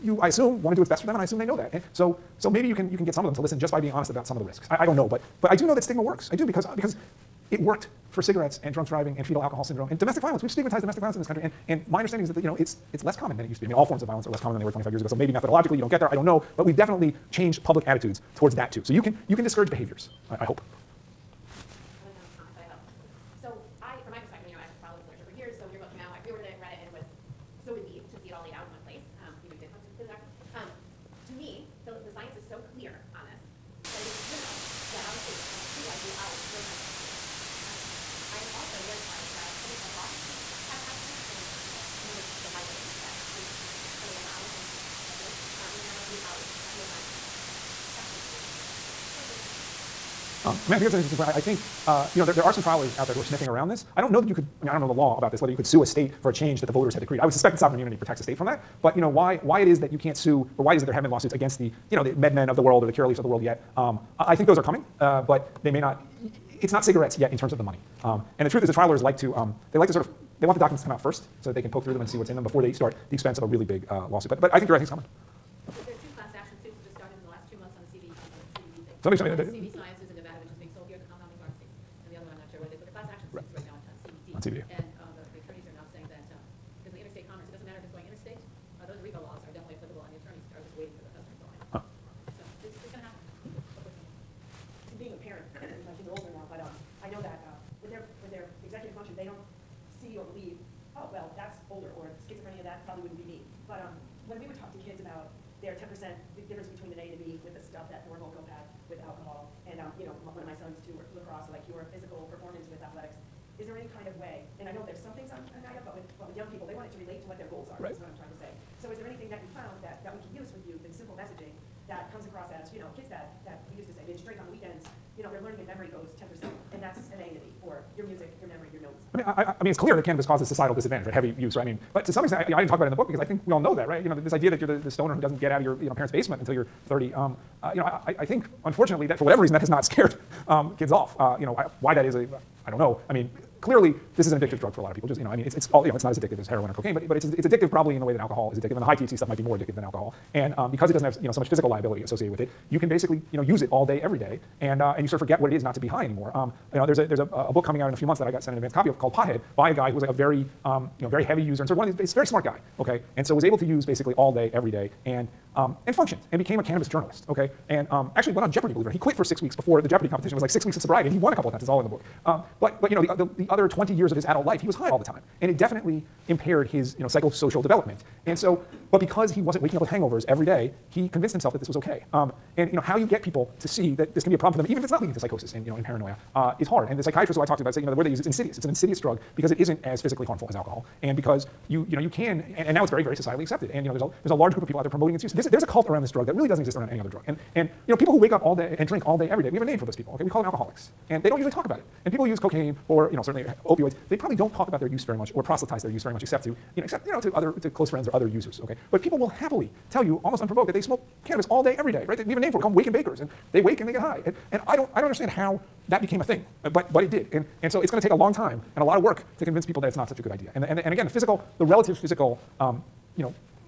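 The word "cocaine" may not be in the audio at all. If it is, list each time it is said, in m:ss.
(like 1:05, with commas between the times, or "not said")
2:26, 3:22.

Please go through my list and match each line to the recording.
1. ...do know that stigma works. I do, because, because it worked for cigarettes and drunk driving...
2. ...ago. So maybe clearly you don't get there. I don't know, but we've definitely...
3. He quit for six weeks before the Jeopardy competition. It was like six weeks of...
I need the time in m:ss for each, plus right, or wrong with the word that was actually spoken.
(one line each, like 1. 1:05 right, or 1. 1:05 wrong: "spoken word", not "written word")
1. 0:05 right
2. 0:15 wrong: "methodologically", not "clearly"
3. 2:48 right.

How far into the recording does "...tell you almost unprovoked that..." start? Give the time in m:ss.
3:29.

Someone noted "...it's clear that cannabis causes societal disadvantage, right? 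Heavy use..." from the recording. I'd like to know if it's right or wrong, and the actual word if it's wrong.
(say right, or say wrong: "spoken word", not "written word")
right.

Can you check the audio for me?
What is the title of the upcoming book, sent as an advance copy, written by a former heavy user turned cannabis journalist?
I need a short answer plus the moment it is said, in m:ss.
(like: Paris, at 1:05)
Pothead, at 2:39.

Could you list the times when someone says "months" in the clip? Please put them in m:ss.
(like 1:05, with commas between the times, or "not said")
1:17, 2:38.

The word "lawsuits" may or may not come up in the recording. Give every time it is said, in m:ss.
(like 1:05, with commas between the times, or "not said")
1:01, 1:14.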